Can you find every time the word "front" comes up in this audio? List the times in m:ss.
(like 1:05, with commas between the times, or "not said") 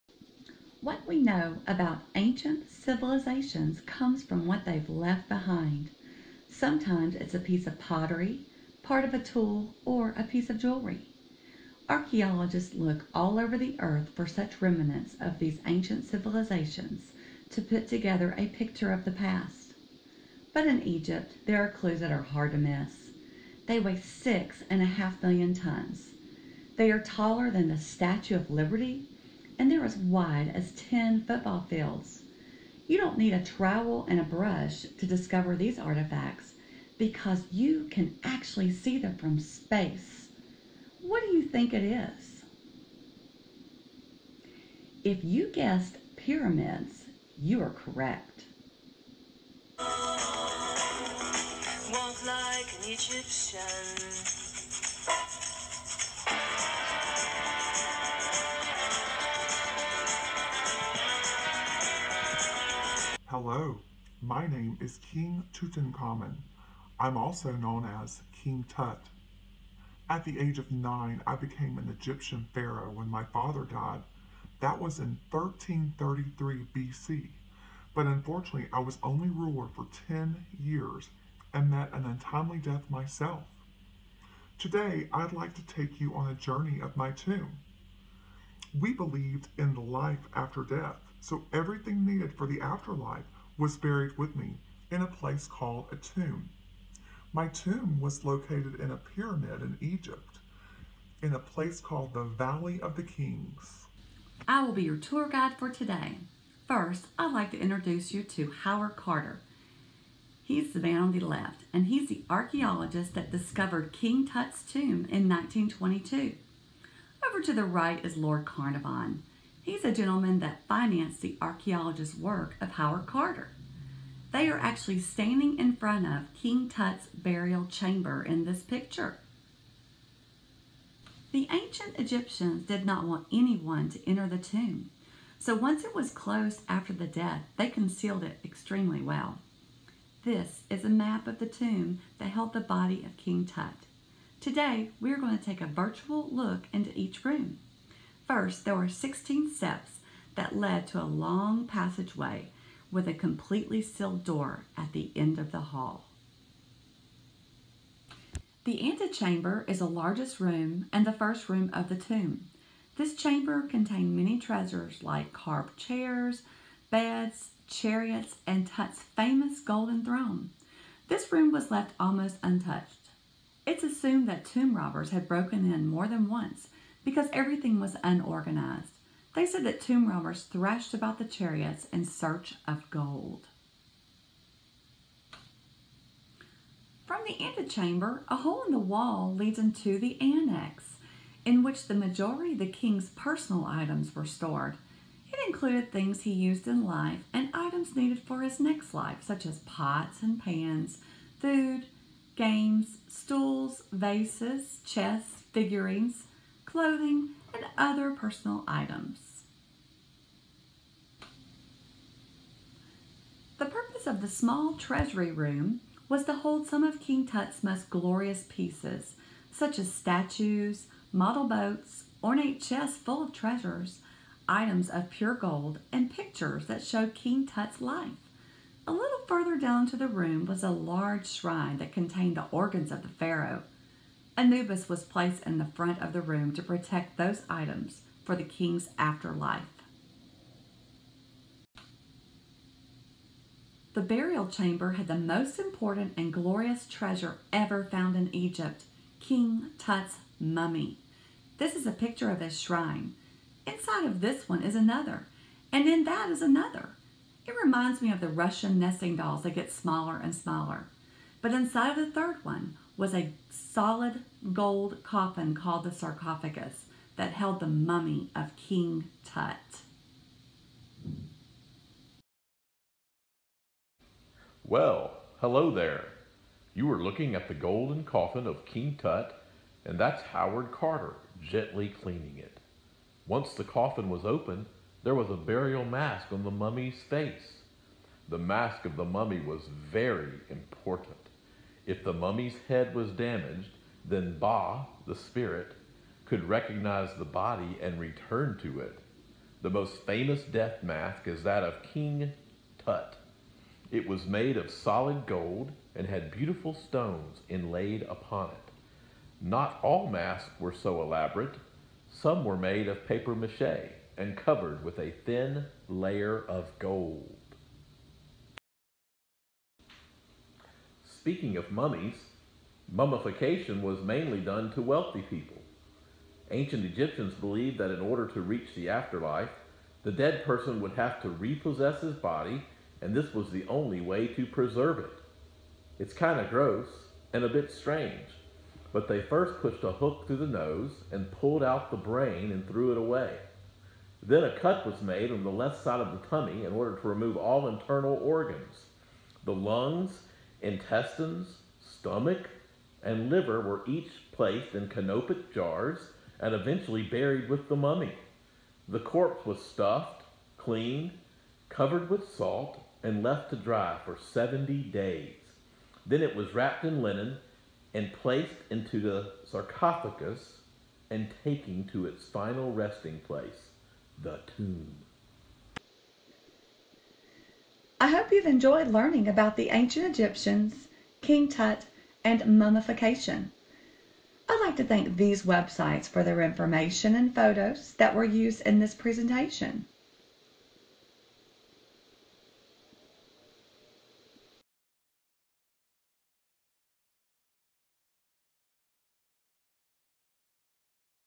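2:05, 3:55.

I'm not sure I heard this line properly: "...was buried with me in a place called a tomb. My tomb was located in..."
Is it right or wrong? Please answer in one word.
right.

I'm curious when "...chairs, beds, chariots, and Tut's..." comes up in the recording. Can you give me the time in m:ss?
2:45.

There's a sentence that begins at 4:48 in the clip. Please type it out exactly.
The mask of the mummy was very important.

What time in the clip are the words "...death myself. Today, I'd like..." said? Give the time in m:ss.
1:22.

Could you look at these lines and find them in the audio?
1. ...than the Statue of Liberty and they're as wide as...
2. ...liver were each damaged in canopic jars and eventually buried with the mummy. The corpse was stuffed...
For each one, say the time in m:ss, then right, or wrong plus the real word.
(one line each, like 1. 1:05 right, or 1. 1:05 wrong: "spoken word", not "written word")
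1. 0:27 right
2. 5:53 wrong: "placed", not "damaged".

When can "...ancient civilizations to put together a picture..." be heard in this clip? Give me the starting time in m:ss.
0:15.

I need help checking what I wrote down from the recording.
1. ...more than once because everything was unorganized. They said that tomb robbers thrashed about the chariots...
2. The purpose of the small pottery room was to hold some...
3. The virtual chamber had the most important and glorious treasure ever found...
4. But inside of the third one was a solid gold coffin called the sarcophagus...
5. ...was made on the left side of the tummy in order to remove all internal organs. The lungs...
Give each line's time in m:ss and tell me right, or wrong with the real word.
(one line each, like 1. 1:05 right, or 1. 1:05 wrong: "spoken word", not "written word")
1. 2:55 right
2. 3:33 wrong: "treasury", not "pottery"
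3. 4:03 wrong: "burial", not "virtual"
4. 4:21 right
5. 5:44 right.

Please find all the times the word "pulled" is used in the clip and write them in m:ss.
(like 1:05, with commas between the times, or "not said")
5:41.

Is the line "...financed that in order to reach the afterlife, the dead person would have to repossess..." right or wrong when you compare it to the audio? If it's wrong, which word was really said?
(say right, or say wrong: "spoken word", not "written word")
wrong: "believed", not "financed".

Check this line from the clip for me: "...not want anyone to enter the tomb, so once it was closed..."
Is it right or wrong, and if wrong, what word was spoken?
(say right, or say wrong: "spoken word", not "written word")
right.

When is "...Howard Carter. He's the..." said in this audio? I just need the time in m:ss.
1:48.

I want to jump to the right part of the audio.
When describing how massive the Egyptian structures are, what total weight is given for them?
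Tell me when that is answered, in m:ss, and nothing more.
0:24.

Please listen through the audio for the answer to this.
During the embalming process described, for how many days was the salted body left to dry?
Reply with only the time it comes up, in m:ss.
6:04.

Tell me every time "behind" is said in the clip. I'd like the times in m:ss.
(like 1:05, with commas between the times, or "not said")
0:05.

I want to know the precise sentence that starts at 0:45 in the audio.
If you guessed pyramids, you are correct.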